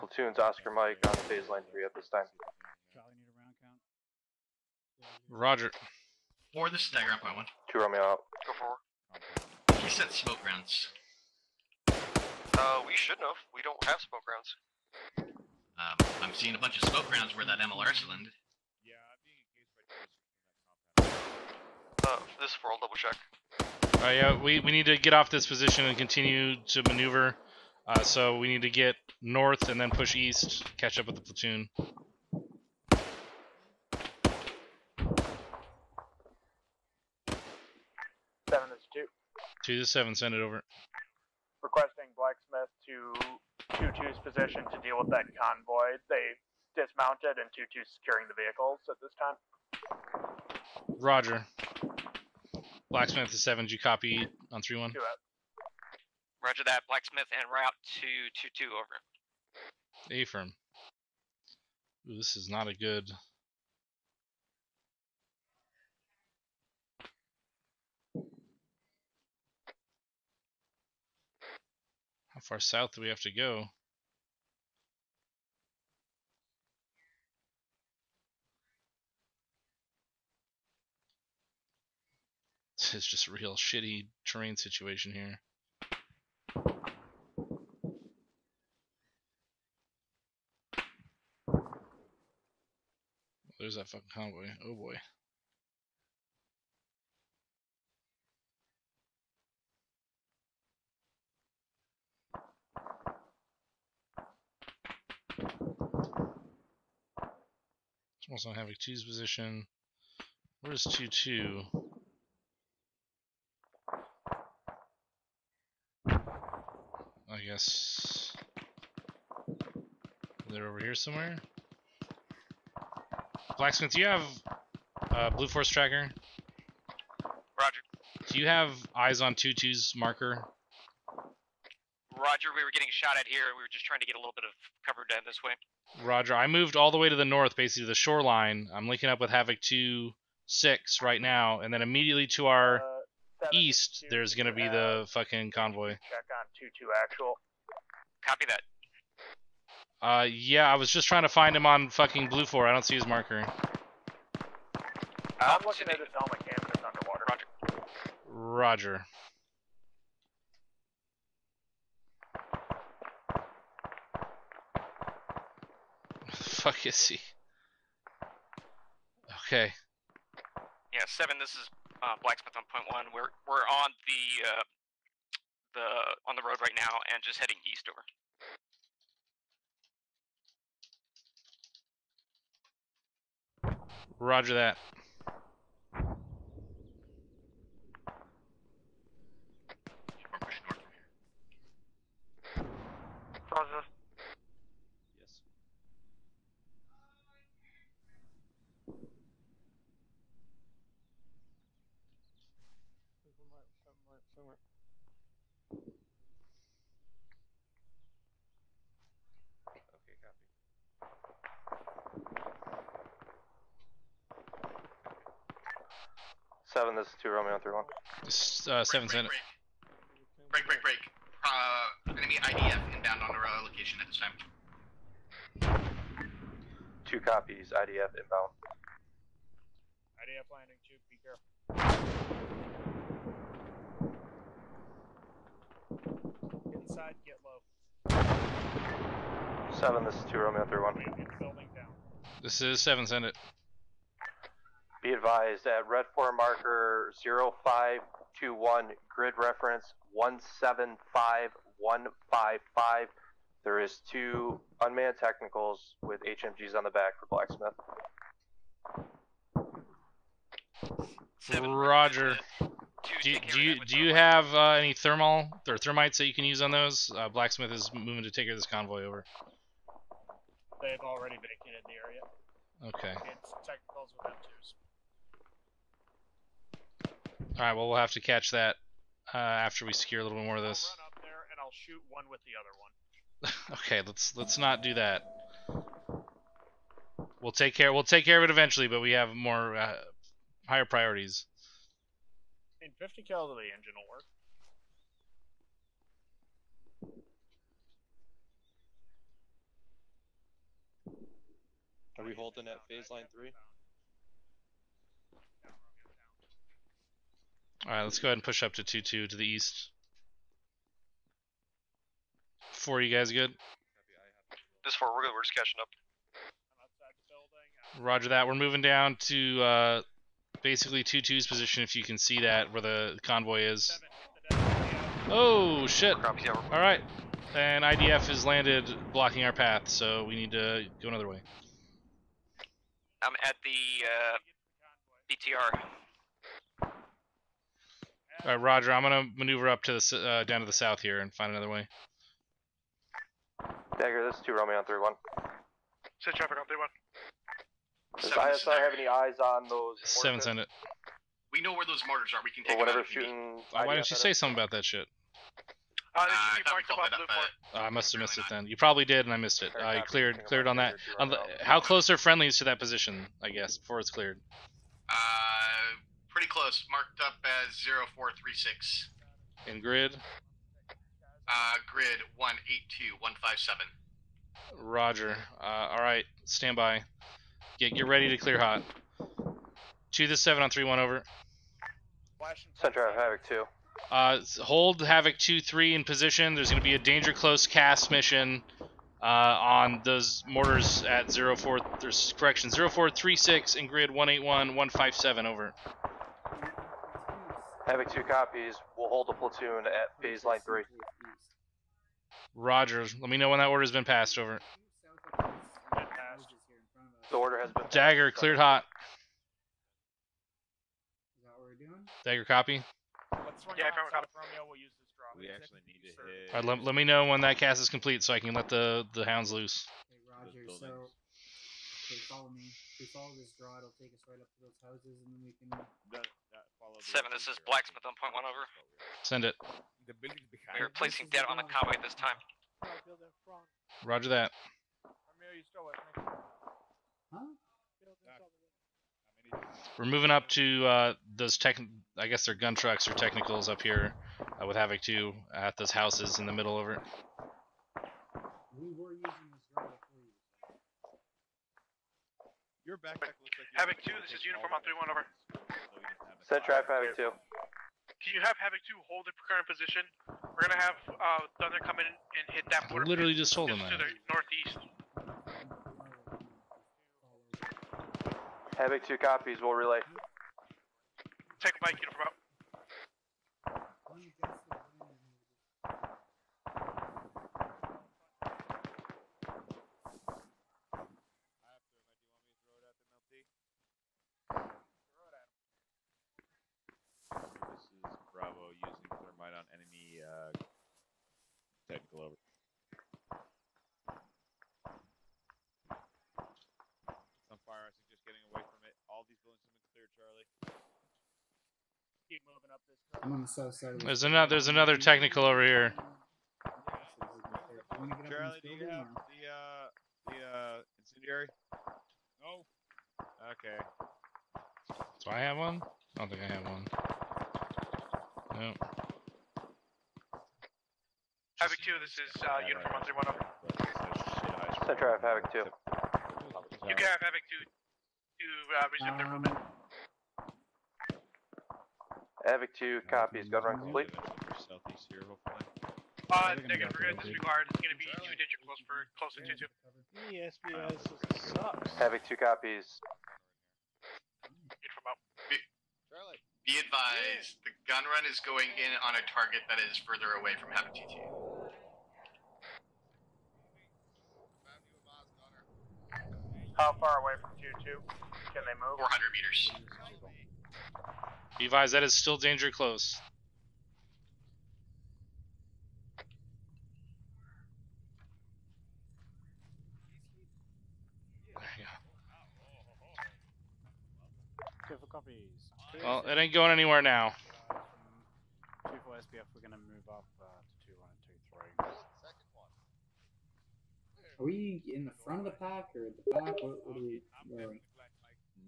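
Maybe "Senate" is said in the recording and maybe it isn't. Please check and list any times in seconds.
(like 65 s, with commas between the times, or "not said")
219 s, 243 s.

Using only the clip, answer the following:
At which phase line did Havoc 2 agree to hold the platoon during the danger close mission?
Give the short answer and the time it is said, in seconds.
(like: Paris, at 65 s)
Phase line 3, at 400 s.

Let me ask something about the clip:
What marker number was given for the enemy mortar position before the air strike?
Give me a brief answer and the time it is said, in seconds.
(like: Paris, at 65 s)
0436, at 366 s.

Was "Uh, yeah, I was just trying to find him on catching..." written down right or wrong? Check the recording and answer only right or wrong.
wrong.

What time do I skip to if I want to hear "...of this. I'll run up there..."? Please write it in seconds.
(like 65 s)
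280 s.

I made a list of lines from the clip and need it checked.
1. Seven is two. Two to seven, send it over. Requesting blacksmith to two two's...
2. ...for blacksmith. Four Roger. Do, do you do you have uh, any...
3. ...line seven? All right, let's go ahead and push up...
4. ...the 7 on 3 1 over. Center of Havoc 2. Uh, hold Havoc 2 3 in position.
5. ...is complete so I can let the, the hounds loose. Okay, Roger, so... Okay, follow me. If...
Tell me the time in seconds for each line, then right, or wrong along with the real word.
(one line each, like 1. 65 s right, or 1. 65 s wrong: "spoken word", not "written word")
1. 38 s right
2. 257 s wrong: "Seven", not "Four"
3. 303 s wrong: "three", not "seven"
4. 380 s right
5. 417 s right.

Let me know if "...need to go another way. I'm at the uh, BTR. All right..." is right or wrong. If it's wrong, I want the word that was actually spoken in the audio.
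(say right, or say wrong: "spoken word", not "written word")
right.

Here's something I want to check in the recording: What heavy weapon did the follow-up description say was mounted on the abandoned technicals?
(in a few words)
M2s.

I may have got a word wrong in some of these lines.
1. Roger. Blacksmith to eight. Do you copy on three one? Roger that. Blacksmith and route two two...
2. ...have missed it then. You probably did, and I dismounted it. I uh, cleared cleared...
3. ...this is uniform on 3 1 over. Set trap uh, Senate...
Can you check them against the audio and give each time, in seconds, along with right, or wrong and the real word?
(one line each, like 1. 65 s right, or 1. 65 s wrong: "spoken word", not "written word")
1. 50 s wrong: "seven", not "eight"
2. 358 s wrong: "missed", not "dismounted"
3. 454 s wrong: "Havoc", not "Senate".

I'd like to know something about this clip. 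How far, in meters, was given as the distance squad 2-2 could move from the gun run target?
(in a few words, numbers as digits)
400.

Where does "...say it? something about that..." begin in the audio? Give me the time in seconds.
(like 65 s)
354 s.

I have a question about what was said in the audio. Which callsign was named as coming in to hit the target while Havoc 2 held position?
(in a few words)
Thunder.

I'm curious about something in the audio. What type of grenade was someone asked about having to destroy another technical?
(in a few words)
Incendiary.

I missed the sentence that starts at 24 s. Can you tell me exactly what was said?
Uh, yeah, we, we need to get off this position and continue to maneuver.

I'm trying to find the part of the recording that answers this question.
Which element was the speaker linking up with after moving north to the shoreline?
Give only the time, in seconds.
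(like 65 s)
139 s.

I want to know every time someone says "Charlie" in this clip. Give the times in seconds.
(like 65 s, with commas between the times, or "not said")
500 s, 508 s, 546 s.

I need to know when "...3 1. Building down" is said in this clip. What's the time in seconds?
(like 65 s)
240 s.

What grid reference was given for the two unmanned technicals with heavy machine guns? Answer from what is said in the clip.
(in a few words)
175155.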